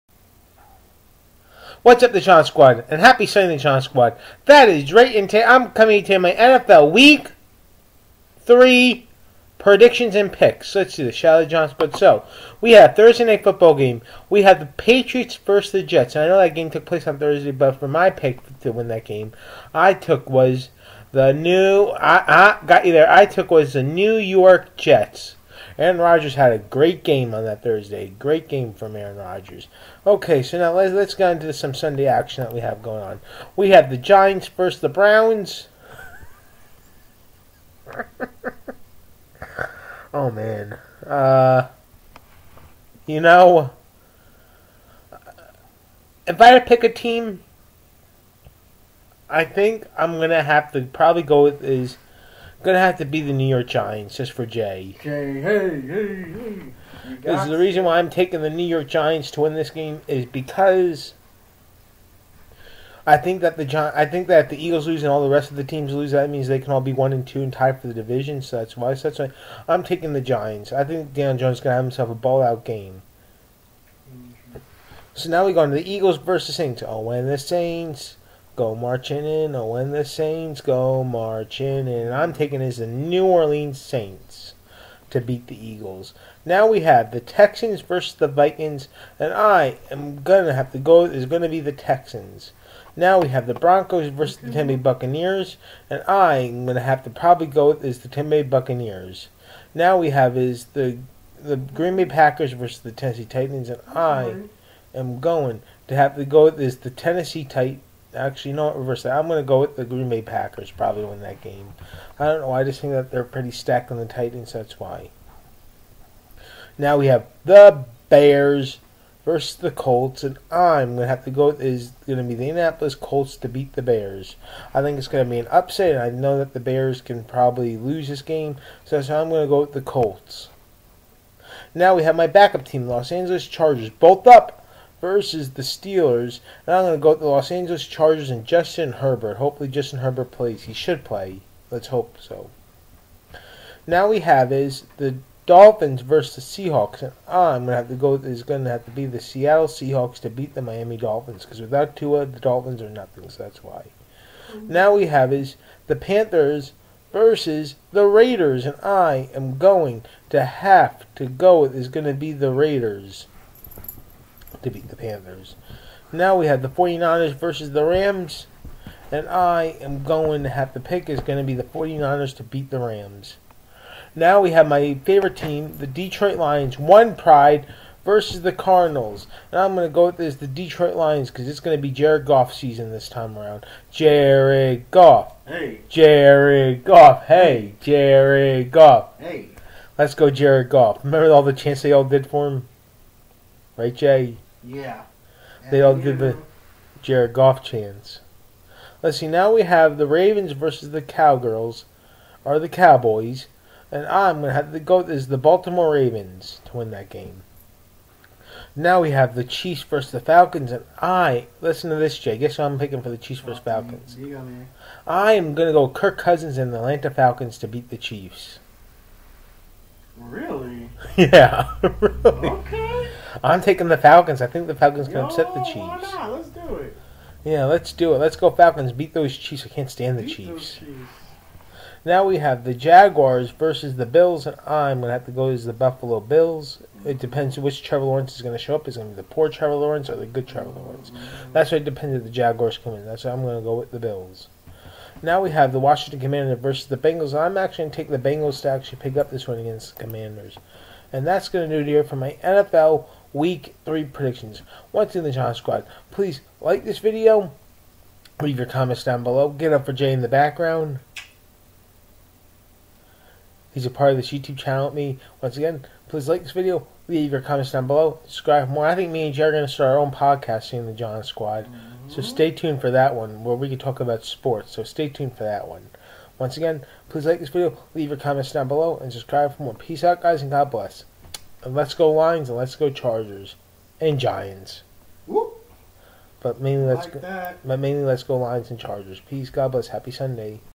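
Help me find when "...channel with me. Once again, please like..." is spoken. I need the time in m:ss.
4:24.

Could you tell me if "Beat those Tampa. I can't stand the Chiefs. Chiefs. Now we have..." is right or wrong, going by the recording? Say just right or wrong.
wrong.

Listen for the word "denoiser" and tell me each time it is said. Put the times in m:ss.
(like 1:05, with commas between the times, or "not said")
not said.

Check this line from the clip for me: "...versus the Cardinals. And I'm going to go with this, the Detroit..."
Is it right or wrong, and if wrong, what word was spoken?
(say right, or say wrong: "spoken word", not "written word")
right.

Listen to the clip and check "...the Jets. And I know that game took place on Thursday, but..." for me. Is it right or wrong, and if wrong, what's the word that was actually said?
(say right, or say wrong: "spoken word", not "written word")
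right.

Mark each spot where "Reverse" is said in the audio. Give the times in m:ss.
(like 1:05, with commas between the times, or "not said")
1:48.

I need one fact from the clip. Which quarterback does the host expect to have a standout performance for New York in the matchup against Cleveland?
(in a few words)
Dan Jones.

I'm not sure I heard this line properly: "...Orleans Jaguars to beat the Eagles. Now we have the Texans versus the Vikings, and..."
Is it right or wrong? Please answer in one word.
wrong.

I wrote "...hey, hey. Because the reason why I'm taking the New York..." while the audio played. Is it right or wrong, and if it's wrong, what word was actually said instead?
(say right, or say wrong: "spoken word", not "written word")
right.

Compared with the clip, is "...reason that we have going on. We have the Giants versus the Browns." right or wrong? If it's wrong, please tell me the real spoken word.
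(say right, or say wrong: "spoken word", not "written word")
wrong: "action", not "reason".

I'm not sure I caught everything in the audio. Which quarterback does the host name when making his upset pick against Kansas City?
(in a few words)
Kirk Cousins.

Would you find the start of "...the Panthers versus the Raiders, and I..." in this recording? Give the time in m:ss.
2:35.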